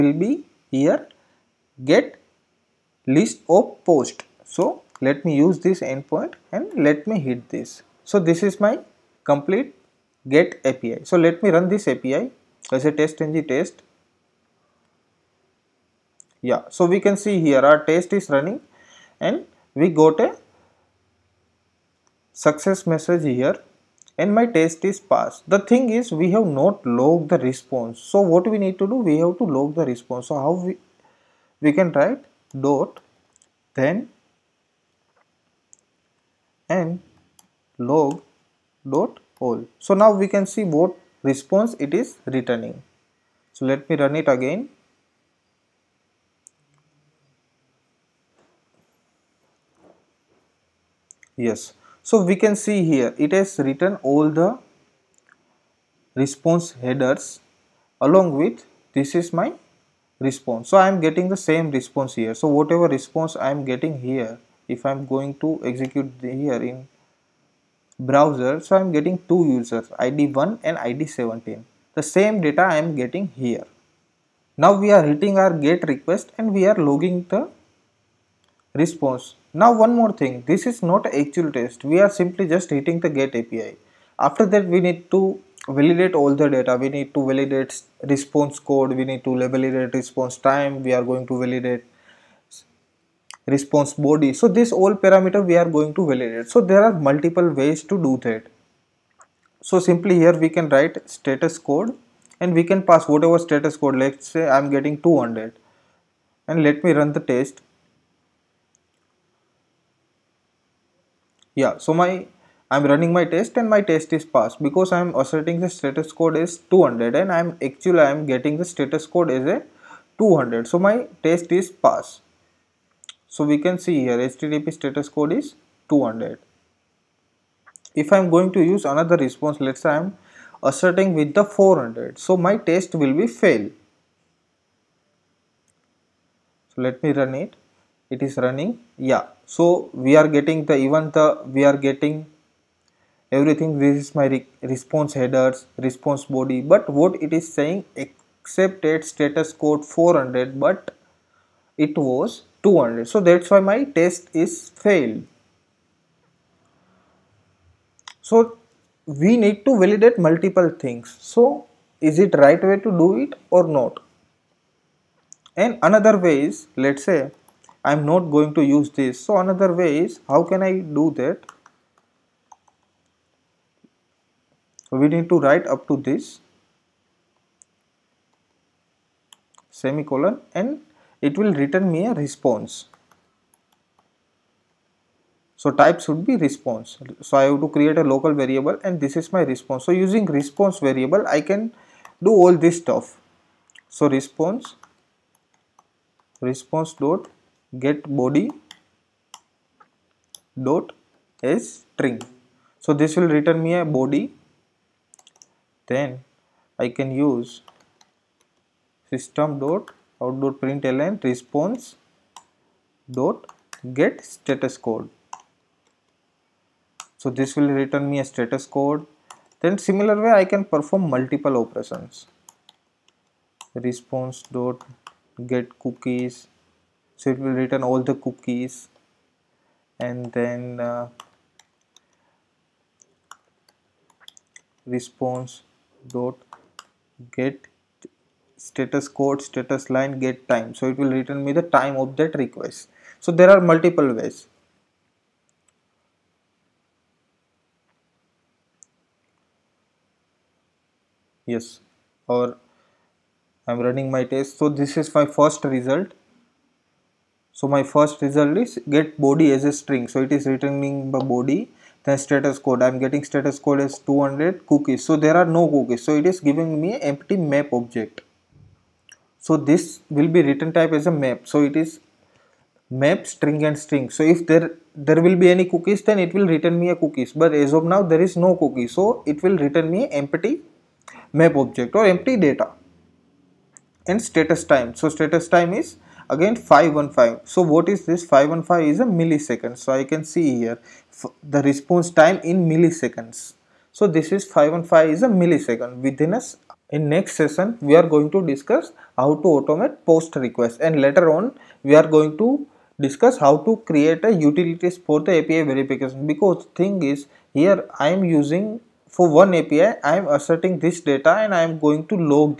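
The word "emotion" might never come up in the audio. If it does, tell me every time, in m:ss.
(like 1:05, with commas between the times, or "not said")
not said.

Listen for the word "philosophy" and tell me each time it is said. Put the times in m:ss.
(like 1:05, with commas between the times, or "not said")
not said.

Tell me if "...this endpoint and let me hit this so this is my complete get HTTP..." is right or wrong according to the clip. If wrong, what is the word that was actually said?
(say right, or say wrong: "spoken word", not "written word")
wrong: "API", not "HTTP".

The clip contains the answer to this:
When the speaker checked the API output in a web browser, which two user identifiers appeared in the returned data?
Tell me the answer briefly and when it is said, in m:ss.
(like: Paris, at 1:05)
1 and 17, at 1:10.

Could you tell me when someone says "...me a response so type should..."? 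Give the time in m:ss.
3:01.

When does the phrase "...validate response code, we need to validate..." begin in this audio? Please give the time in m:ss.
1:27.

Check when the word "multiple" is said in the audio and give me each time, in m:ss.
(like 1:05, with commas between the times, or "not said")
1:36, 2:40, 3:41, 4:03.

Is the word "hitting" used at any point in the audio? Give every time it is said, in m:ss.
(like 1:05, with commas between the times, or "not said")
1:15, 1:22.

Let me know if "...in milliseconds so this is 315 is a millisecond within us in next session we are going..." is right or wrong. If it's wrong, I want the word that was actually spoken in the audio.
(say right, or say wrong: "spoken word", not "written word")
wrong: "515", not "315".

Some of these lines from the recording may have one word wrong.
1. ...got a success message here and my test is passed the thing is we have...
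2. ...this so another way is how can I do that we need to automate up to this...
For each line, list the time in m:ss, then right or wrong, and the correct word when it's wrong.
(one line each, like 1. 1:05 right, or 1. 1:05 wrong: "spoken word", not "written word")
1. 0:19 right
2. 2:48 wrong: "write", not "automate".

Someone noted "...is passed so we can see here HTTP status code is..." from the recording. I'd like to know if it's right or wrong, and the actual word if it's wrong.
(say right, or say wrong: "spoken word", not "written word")
right.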